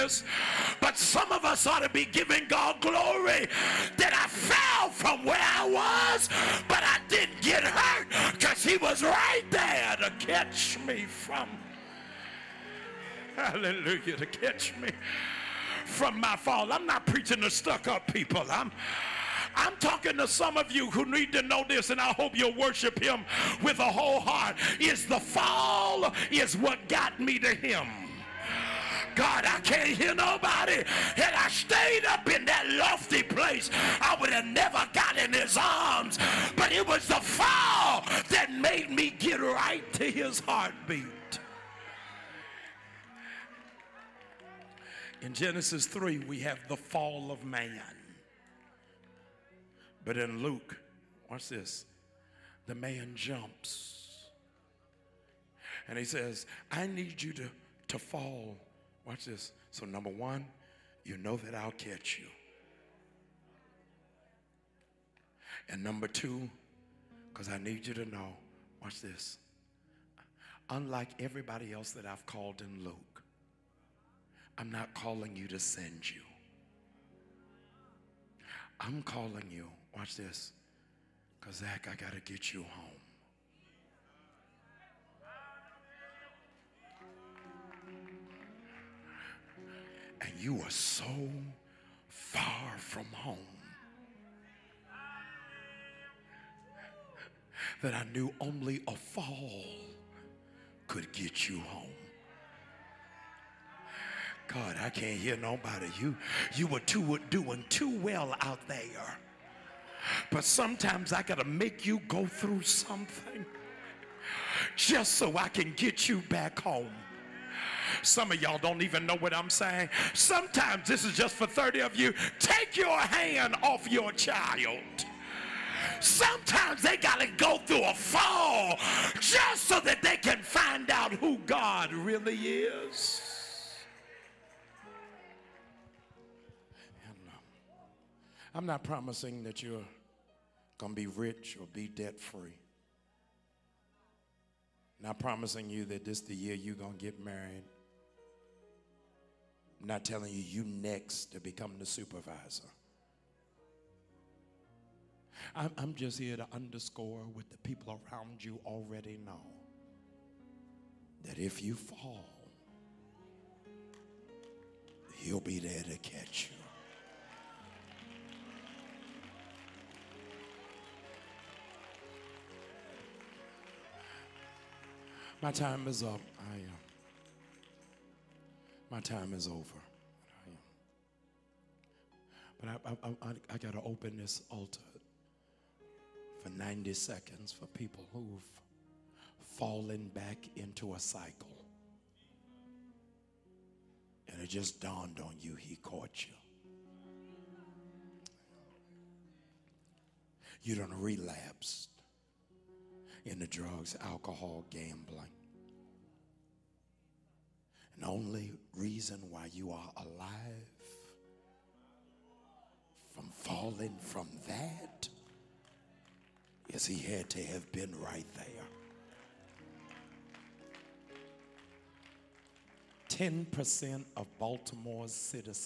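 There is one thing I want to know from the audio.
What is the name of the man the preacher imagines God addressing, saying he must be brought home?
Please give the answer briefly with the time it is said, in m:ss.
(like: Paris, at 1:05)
Zach, at 1:21.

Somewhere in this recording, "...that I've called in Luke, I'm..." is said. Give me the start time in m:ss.
1:11.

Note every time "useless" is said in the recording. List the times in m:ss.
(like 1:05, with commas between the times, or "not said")
not said.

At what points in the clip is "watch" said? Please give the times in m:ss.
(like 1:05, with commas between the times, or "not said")
0:51, 0:59, 1:08, 1:19.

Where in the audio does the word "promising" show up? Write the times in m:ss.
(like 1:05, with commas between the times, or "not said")
2:18, 2:25.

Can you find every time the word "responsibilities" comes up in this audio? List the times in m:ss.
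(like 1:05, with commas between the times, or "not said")
not said.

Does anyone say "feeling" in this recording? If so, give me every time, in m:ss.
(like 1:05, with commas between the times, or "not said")
not said.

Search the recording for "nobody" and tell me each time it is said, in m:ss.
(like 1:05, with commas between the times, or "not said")
0:30, 1:45.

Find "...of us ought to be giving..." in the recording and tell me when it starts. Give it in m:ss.
0:01.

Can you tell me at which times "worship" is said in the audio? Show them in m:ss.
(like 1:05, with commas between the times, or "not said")
0:22.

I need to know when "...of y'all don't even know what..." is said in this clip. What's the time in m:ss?
1:58.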